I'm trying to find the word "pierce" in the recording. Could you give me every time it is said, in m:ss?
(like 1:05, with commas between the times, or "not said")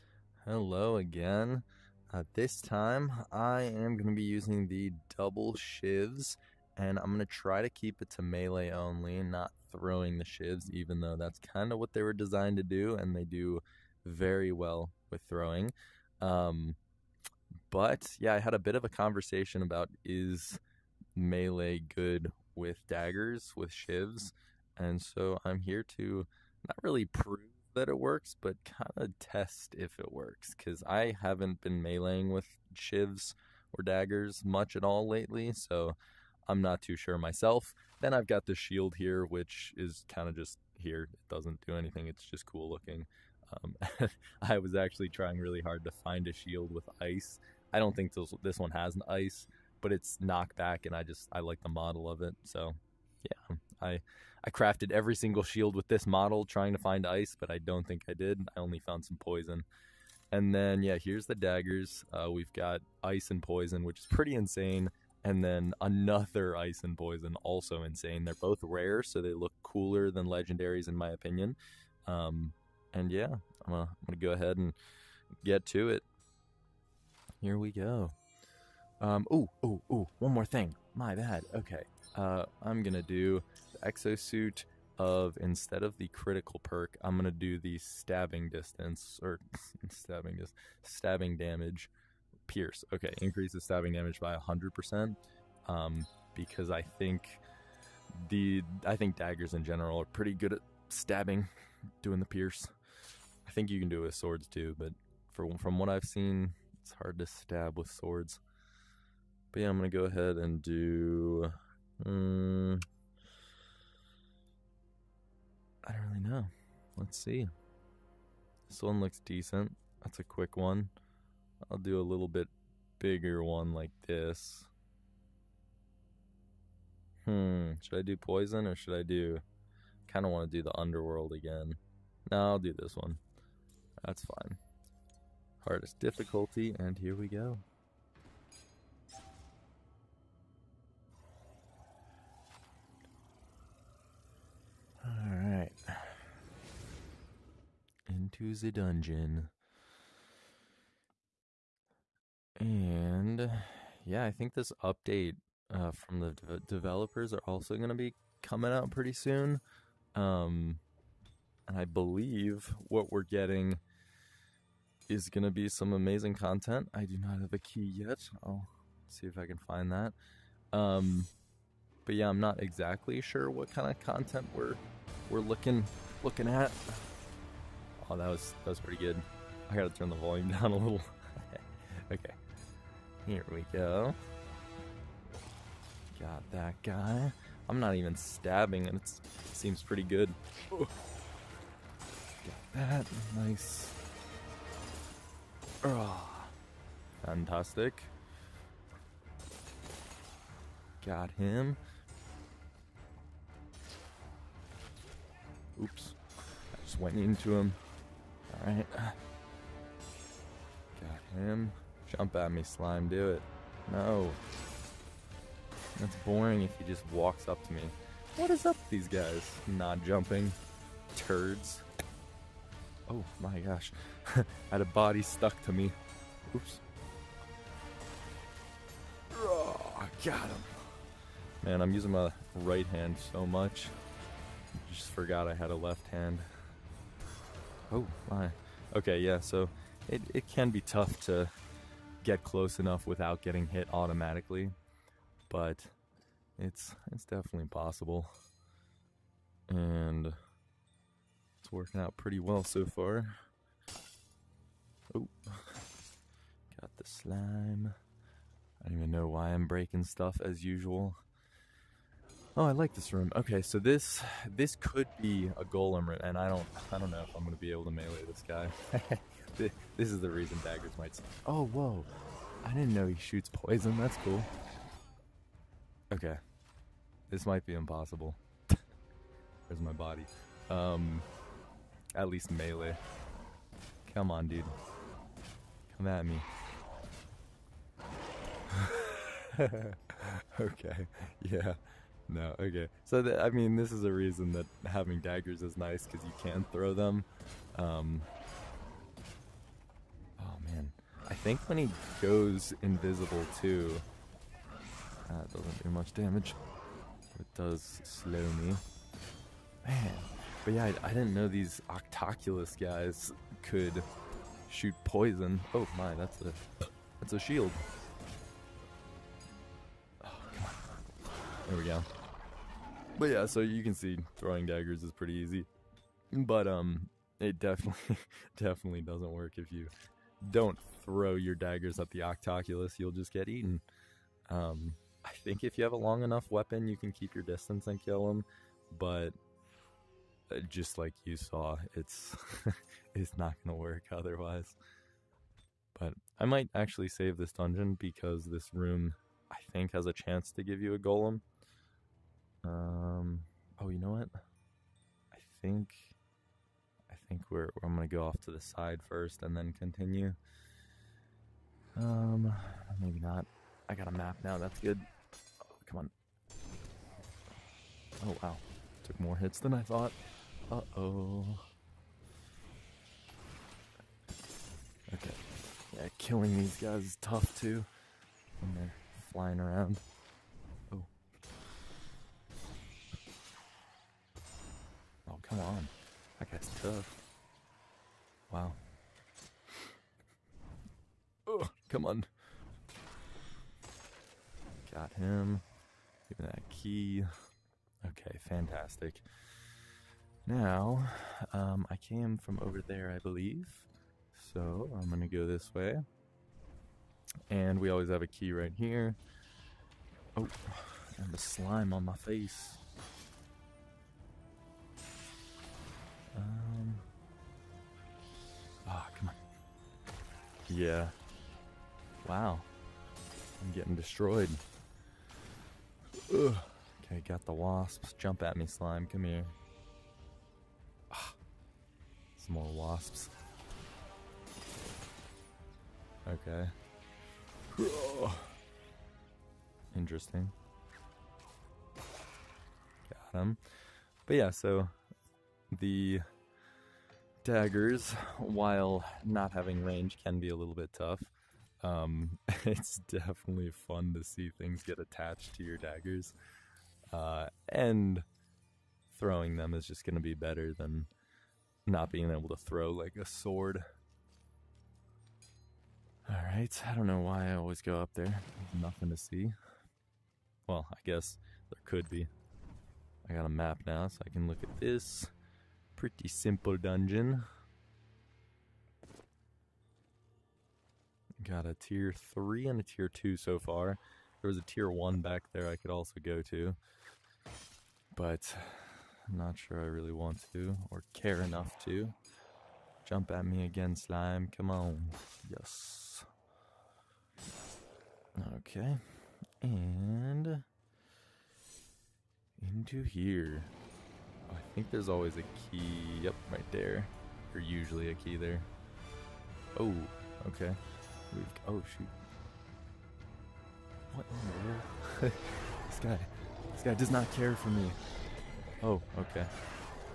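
1:32, 1:42.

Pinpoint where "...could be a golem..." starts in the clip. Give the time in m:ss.
4:24.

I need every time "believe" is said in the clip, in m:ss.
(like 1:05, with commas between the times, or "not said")
2:41, 6:43.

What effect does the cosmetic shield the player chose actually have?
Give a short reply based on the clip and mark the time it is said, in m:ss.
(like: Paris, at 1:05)
knockback, at 0:50.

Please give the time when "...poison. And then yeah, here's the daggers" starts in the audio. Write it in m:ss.
0:59.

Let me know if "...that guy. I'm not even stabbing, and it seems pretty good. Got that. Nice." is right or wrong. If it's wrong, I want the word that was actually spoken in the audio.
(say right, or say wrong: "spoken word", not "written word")
right.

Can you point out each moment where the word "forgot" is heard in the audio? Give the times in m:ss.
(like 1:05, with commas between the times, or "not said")
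3:55.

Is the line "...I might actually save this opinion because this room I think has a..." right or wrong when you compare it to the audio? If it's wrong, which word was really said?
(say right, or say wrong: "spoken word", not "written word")
wrong: "dungeon", not "opinion".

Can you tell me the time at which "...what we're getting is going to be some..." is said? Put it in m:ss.
2:42.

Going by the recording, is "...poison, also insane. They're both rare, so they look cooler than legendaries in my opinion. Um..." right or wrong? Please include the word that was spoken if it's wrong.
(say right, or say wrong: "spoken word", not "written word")
right.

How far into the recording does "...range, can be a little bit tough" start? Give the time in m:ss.
7:29.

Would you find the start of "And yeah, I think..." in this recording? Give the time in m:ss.
2:32.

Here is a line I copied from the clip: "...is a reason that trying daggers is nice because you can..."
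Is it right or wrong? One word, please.
wrong.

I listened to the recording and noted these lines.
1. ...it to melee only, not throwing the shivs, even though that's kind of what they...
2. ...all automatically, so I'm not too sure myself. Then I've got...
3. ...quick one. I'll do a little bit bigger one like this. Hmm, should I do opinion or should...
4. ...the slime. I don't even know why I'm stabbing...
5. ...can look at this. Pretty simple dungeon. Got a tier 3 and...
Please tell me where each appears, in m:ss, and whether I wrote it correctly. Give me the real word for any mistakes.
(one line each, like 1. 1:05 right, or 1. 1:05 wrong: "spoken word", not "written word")
1. 0:08 right
2. 0:34 wrong: "lately", not "automatically"
3. 2:00 wrong: "poison", not "opinion"
4. 4:16 wrong: "breaking", not "stabbing"
5. 7:54 right.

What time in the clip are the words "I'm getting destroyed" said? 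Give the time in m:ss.
7:03.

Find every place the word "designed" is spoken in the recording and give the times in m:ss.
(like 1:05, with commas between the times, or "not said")
0:12.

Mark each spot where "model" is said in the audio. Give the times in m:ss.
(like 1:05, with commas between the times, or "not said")
0:51, 0:56.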